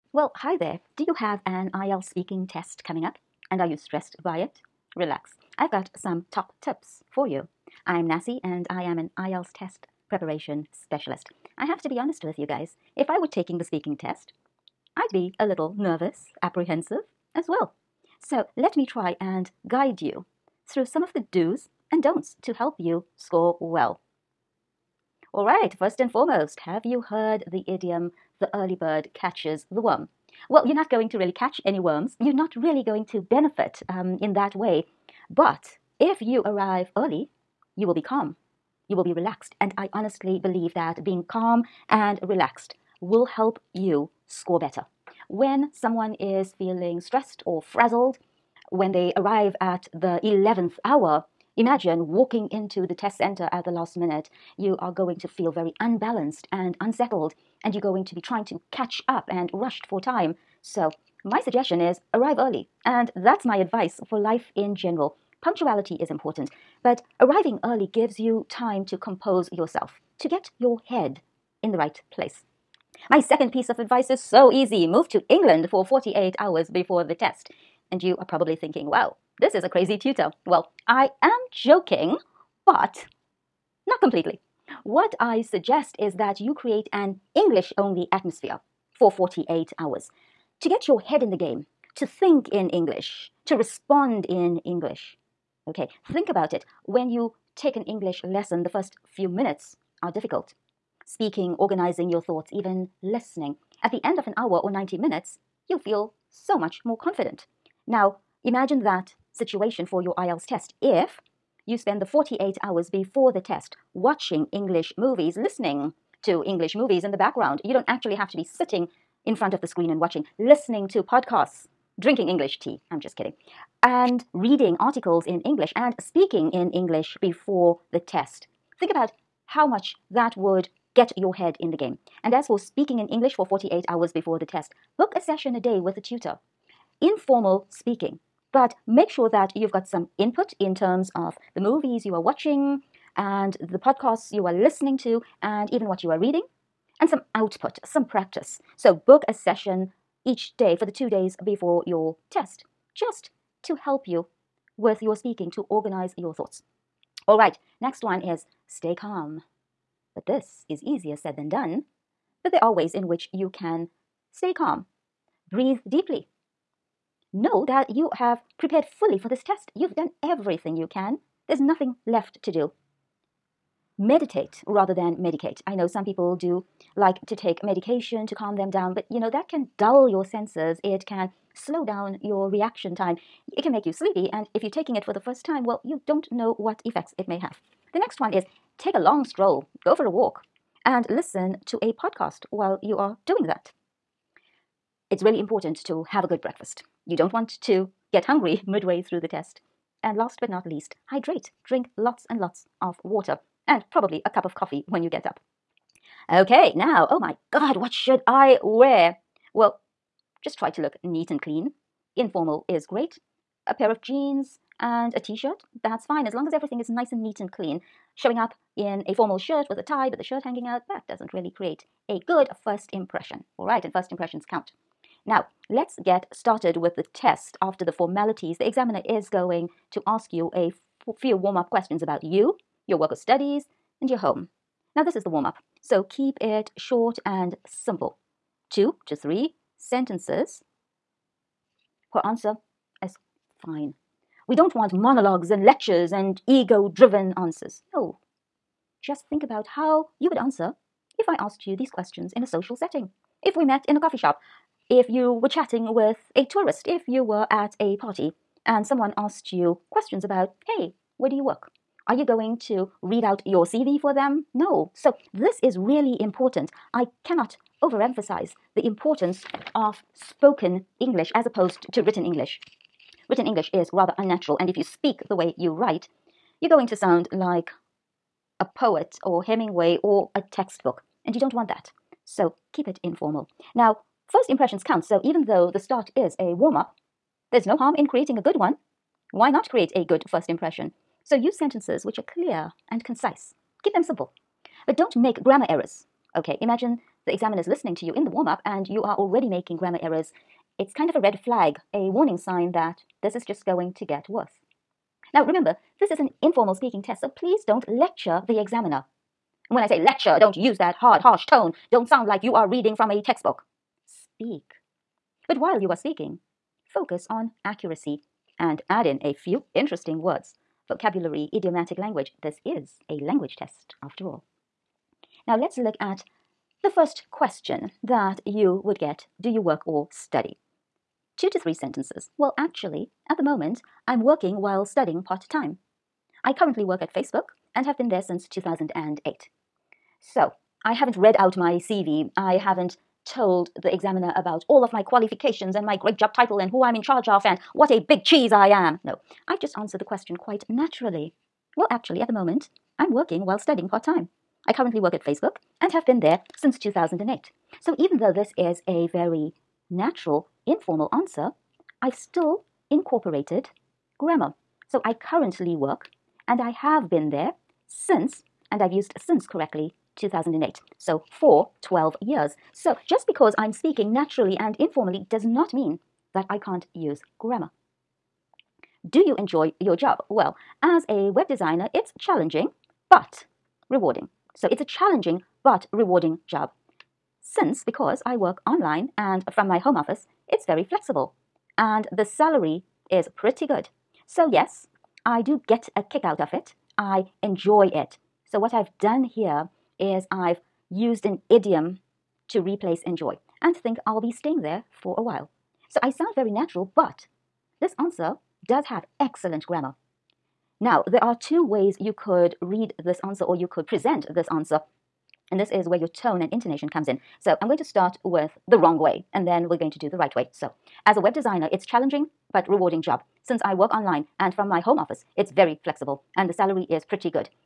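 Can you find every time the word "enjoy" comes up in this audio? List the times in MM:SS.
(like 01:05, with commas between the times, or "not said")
06:19, 06:37, 06:43.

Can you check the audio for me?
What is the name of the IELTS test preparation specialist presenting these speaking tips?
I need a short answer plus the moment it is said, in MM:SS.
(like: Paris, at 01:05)
Nas Cee, at 00:08.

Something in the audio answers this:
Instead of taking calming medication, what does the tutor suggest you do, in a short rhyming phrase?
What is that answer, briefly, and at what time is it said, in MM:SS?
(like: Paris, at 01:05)
Meditate, at 02:53.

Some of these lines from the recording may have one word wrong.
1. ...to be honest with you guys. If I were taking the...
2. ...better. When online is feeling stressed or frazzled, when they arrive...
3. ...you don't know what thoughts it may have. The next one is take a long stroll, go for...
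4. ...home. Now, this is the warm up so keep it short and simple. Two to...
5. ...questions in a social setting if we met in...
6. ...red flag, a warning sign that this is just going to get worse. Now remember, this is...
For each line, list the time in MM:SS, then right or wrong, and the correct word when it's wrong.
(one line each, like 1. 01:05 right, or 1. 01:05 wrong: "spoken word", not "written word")
1. 00:11 right
2. 00:44 wrong: "someone", not "online"
3. 03:05 wrong: "effects", not "thoughts"
4. 03:54 right
5. 04:11 right
6. 05:01 right.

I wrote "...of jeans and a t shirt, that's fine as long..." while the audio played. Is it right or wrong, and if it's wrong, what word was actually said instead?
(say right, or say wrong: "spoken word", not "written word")
right.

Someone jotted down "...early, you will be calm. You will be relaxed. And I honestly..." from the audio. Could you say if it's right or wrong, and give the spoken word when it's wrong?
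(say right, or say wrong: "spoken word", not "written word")
right.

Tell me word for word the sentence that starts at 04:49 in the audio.
Why not create a good first impression?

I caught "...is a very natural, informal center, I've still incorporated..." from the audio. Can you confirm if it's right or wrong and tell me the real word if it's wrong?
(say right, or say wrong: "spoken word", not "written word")
wrong: "answer", not "center".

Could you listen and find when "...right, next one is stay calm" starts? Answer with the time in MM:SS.
02:37.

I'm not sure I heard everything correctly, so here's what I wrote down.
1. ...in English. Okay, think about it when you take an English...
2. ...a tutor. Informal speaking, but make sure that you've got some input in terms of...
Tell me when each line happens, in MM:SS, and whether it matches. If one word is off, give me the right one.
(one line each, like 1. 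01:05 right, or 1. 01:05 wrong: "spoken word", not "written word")
1. 01:34 right
2. 02:15 right.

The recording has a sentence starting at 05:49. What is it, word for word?
No, I've just answered the question quite naturally.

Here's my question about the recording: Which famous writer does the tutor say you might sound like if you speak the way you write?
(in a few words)
Hemingway.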